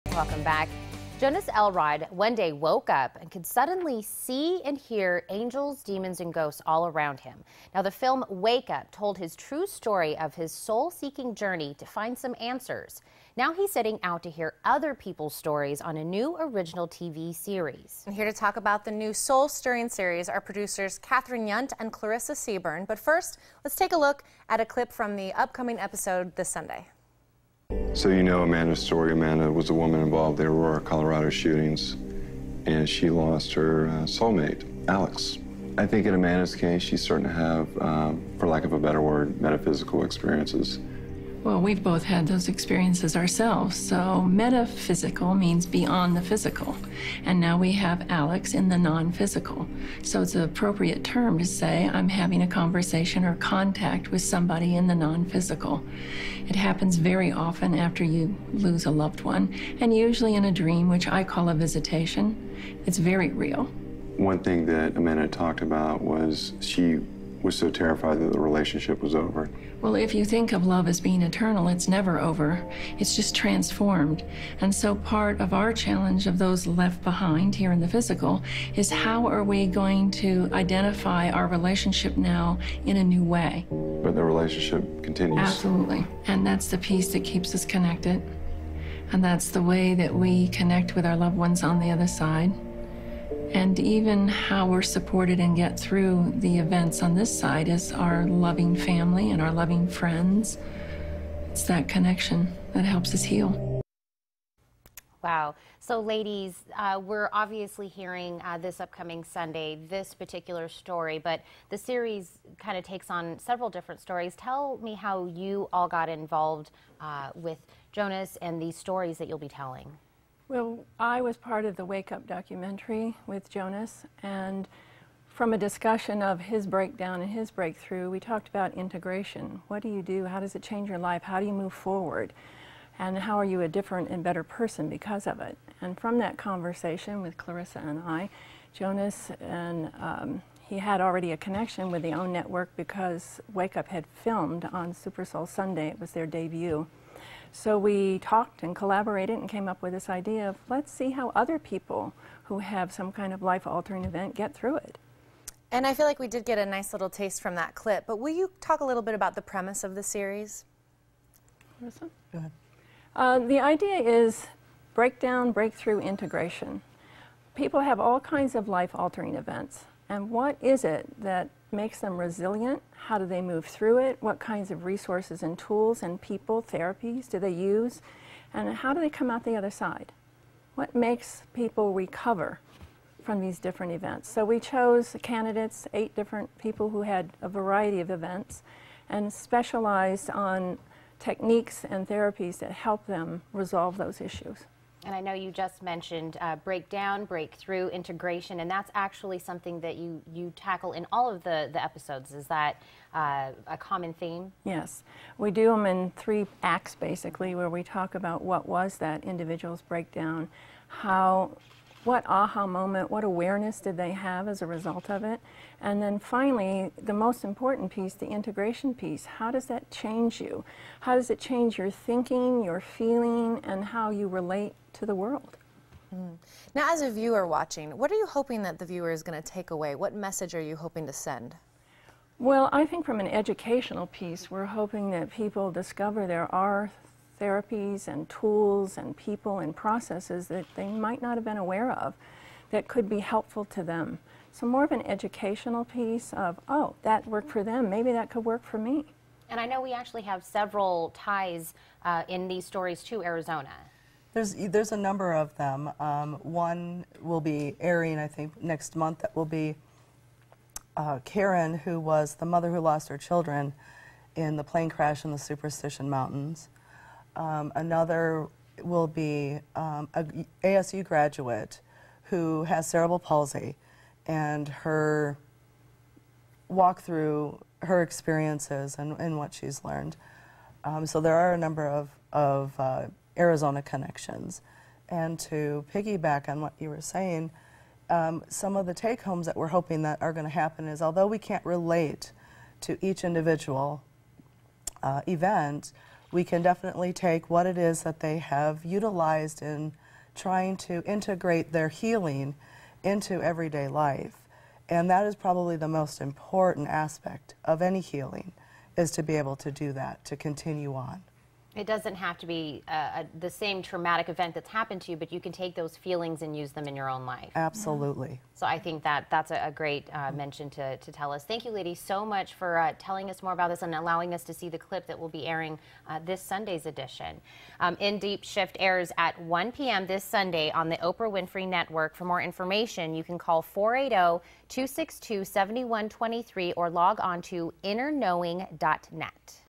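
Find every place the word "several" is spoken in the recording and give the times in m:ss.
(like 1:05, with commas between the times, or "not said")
1:53, 4:10.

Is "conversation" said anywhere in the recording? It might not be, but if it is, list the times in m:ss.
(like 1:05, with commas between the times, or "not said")
0:52, 2:16.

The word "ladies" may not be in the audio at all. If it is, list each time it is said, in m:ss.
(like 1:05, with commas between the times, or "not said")
1:45, 5:21.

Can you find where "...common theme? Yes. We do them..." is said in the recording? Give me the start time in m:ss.
3:23.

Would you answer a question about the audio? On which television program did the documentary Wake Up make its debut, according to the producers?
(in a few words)
Super Soul Sunday.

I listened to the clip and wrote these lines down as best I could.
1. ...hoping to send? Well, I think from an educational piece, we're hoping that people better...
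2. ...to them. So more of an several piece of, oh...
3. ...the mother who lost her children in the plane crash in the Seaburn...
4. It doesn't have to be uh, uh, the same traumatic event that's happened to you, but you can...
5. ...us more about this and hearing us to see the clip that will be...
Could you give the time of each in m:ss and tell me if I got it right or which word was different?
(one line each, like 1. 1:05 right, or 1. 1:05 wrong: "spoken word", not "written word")
1. 3:50 wrong: "discover", not "better"
2. 4:03 wrong: "educational", not "several"
3. 4:22 wrong: "Superstition", not "Seaburn"
4. 5:11 right
5. 5:23 wrong: "allowing", not "hearing".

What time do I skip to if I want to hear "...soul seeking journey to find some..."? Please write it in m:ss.
0:10.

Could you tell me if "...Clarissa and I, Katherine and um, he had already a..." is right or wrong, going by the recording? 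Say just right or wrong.
wrong.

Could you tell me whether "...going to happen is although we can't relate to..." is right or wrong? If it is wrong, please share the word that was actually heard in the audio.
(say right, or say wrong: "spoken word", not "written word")
right.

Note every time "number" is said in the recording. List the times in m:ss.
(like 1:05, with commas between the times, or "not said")
4:14, 4:41.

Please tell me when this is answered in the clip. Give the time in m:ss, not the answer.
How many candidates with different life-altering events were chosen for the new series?
3:05.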